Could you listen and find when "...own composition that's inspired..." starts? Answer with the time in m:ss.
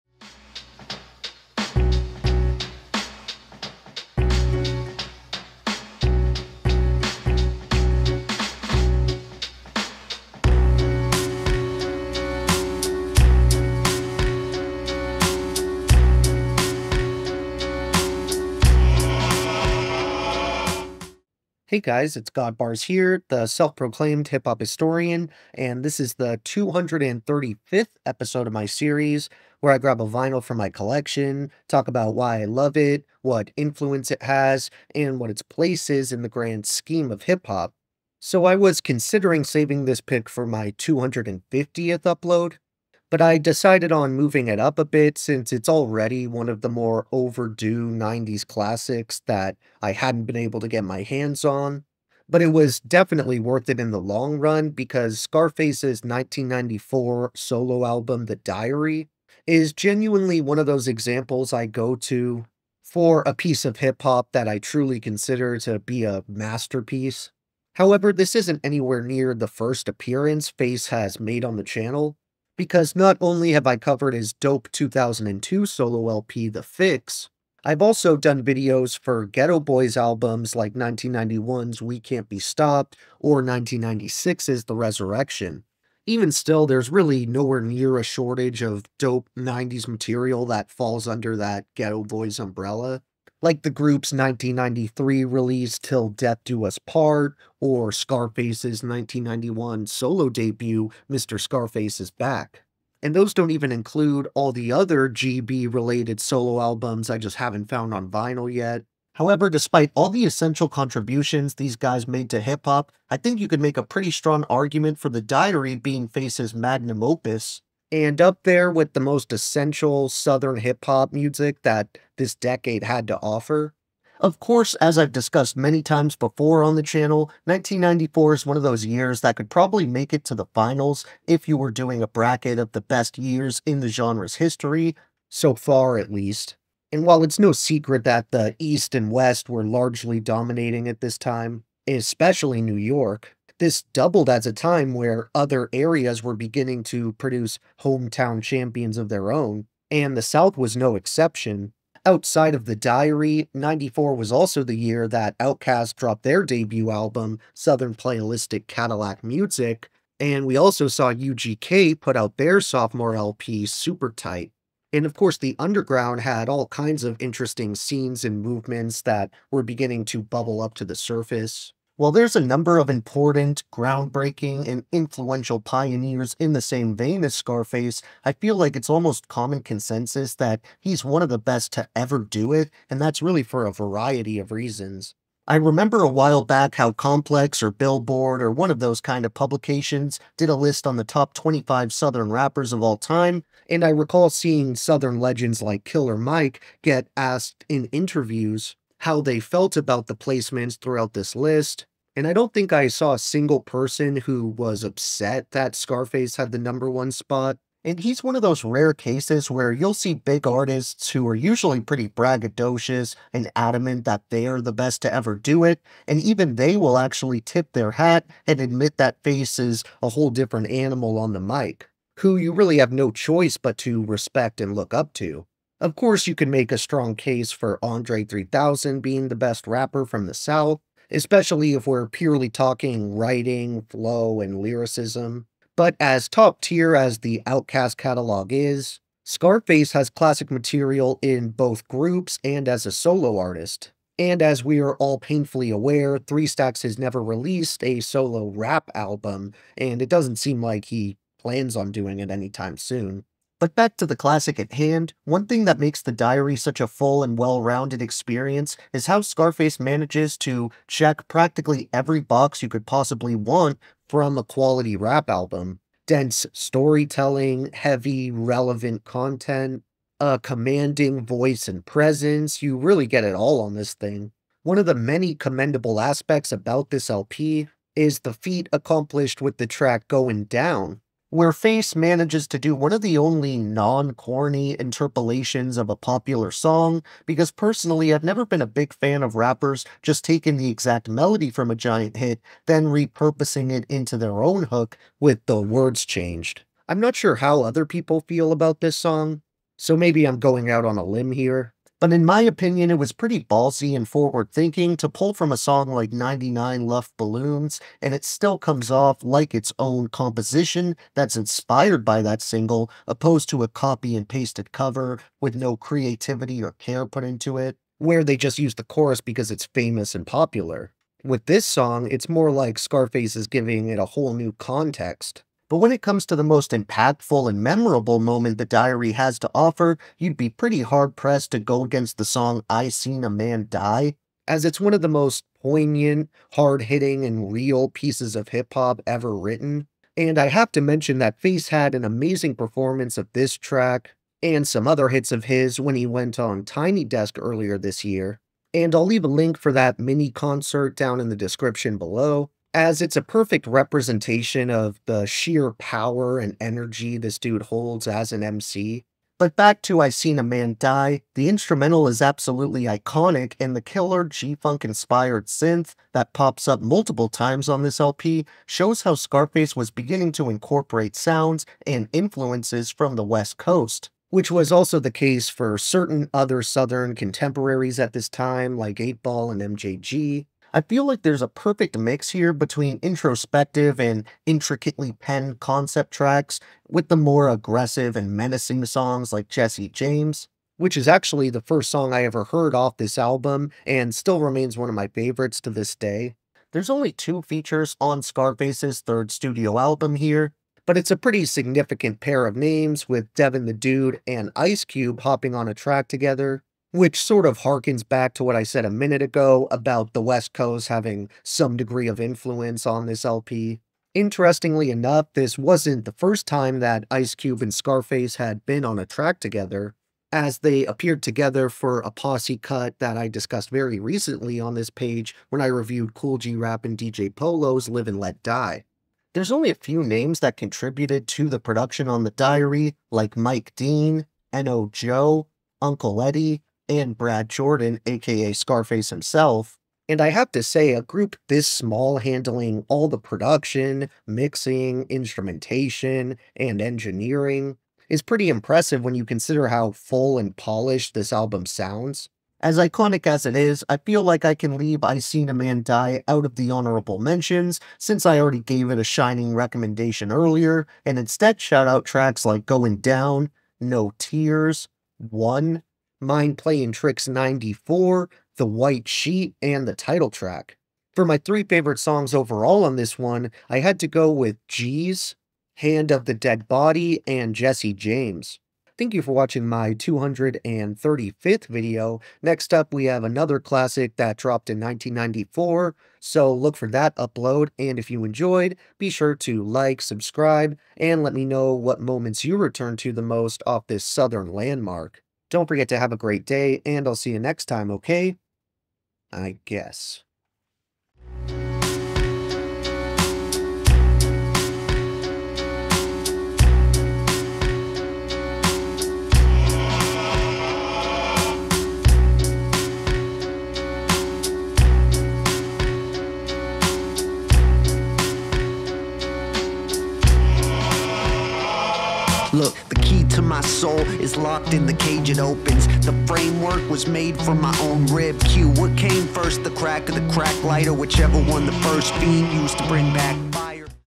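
5:09.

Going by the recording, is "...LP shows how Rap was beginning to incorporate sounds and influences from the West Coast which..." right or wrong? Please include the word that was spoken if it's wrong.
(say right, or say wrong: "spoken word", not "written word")
wrong: "Scarface", not "Rap".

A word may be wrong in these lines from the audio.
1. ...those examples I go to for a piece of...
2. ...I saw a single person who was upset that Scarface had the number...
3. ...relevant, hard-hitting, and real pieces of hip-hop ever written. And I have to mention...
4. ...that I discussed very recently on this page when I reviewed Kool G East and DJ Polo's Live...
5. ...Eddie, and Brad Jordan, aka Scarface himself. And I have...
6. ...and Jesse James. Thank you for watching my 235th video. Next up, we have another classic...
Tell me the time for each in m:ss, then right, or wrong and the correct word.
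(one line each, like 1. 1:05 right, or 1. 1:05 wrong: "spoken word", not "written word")
1. 1:00 right
2. 3:22 right
3. 5:35 wrong: "poignant", not "relevant"
4. 7:02 wrong: "Rap", not "East"
5. 7:16 right
6. 7:57 right.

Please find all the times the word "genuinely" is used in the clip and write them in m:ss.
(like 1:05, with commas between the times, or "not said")
0:59.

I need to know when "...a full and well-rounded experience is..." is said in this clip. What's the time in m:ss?
4:16.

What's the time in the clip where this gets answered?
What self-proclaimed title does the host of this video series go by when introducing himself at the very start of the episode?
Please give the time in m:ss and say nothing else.
0:22.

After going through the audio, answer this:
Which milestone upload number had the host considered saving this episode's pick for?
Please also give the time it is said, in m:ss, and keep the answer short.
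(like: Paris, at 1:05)
250th, at 0:40.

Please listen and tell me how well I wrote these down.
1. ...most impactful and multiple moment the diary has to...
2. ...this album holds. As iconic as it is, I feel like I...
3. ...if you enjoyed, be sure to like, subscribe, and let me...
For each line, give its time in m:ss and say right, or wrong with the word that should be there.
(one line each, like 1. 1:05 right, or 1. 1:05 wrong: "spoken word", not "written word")
1. 5:26 wrong: "memorable", not "multiple"
2. 7:31 wrong: "sounds", not "holds"
3. 8:07 right.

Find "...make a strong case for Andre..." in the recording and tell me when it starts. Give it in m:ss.
3:46.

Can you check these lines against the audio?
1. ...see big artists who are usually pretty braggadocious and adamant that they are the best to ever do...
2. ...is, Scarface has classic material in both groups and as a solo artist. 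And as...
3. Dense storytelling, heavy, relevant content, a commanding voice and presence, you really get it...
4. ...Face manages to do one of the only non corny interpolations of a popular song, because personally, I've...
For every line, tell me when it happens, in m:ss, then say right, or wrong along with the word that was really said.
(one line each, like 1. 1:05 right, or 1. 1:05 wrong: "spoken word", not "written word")
1. 3:29 right
2. 3:58 right
3. 4:26 right
4. 4:41 right.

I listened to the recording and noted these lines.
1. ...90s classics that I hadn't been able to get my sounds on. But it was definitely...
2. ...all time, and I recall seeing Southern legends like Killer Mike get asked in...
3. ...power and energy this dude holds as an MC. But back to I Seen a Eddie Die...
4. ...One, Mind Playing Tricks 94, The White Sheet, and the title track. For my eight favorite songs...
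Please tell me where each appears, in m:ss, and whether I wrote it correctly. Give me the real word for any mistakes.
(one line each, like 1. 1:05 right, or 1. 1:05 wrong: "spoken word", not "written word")
1. 0:47 wrong: "hands", not "sounds"
2. 3:12 right
3. 5:55 wrong: "Man", not "Eddie"
4. 7:45 wrong: "three", not "eight".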